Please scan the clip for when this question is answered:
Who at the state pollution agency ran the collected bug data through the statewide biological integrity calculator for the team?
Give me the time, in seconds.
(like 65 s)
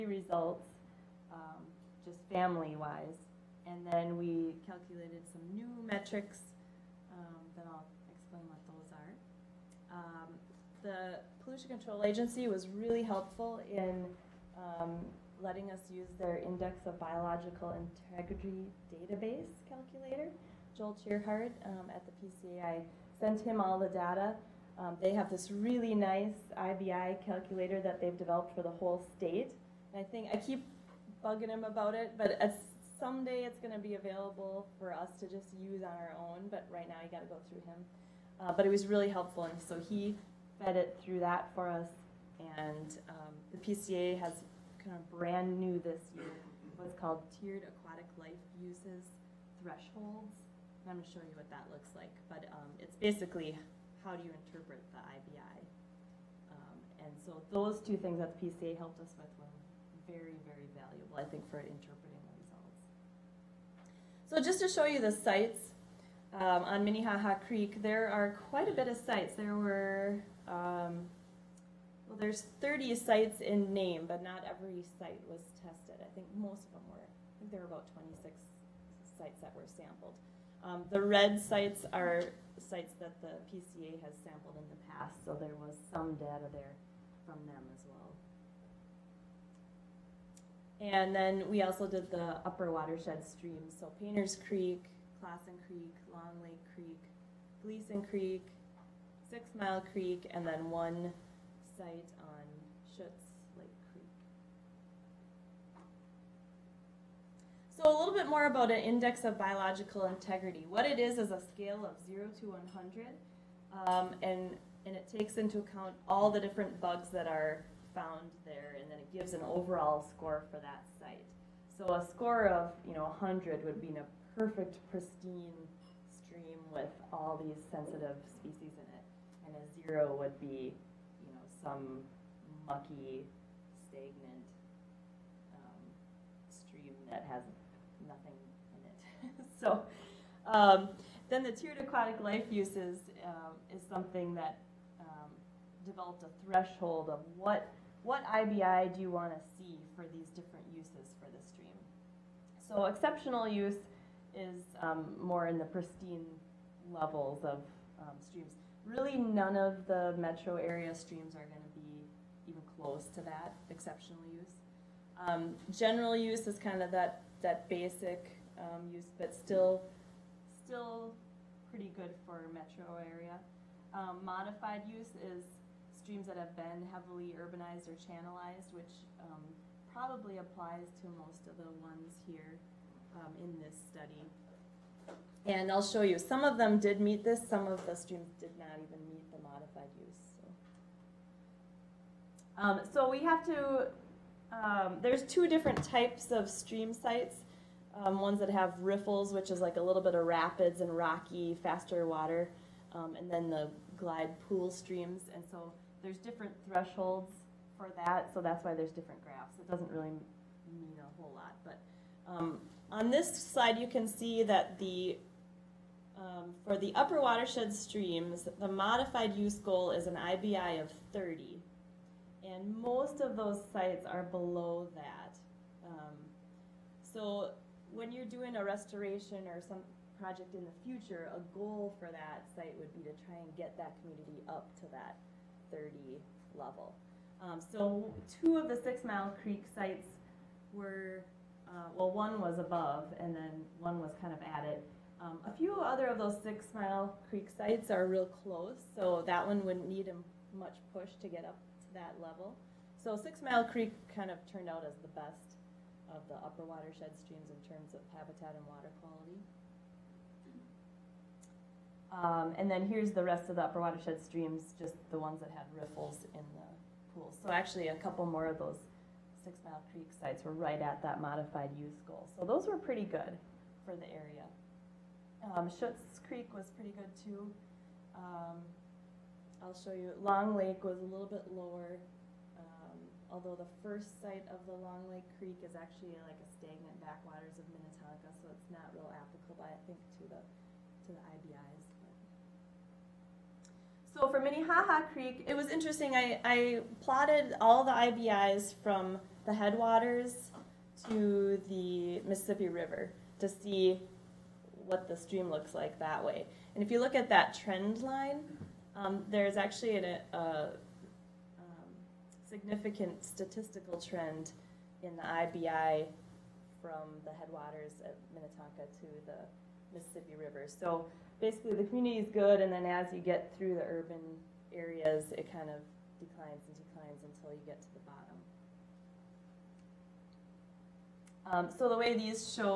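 20 s.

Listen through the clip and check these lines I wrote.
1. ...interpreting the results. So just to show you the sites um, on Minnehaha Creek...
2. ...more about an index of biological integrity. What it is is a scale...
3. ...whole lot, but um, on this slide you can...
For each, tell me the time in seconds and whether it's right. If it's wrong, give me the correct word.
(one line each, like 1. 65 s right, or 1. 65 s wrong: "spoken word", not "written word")
1. 61 s right
2. 108 s right
3. 211 s right.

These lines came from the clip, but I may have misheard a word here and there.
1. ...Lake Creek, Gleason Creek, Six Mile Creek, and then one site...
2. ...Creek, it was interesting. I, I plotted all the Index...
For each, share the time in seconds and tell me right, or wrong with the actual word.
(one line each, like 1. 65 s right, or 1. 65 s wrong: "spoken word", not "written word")
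1. 96 s right
2. 295 s wrong: "IBIs", not "Index".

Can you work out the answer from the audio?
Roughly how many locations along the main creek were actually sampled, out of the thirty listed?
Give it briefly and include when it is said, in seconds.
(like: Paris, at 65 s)
26, at 77 s.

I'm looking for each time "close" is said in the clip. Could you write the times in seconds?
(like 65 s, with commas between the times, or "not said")
162 s, 248 s.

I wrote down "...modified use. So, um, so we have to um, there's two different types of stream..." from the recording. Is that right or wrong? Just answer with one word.
right.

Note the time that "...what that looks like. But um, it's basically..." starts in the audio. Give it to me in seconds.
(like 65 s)
51 s.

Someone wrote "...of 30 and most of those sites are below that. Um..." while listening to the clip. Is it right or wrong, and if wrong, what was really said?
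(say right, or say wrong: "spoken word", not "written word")
right.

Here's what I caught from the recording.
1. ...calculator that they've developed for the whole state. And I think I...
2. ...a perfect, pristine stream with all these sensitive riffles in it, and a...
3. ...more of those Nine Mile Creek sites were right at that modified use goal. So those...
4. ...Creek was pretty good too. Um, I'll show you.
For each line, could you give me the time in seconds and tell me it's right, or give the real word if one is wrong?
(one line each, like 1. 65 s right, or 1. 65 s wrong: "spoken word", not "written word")
1. 27 s right
2. 123 s wrong: "species", not "riffles"
3. 268 s wrong: "Six", not "Nine"
4. 276 s right.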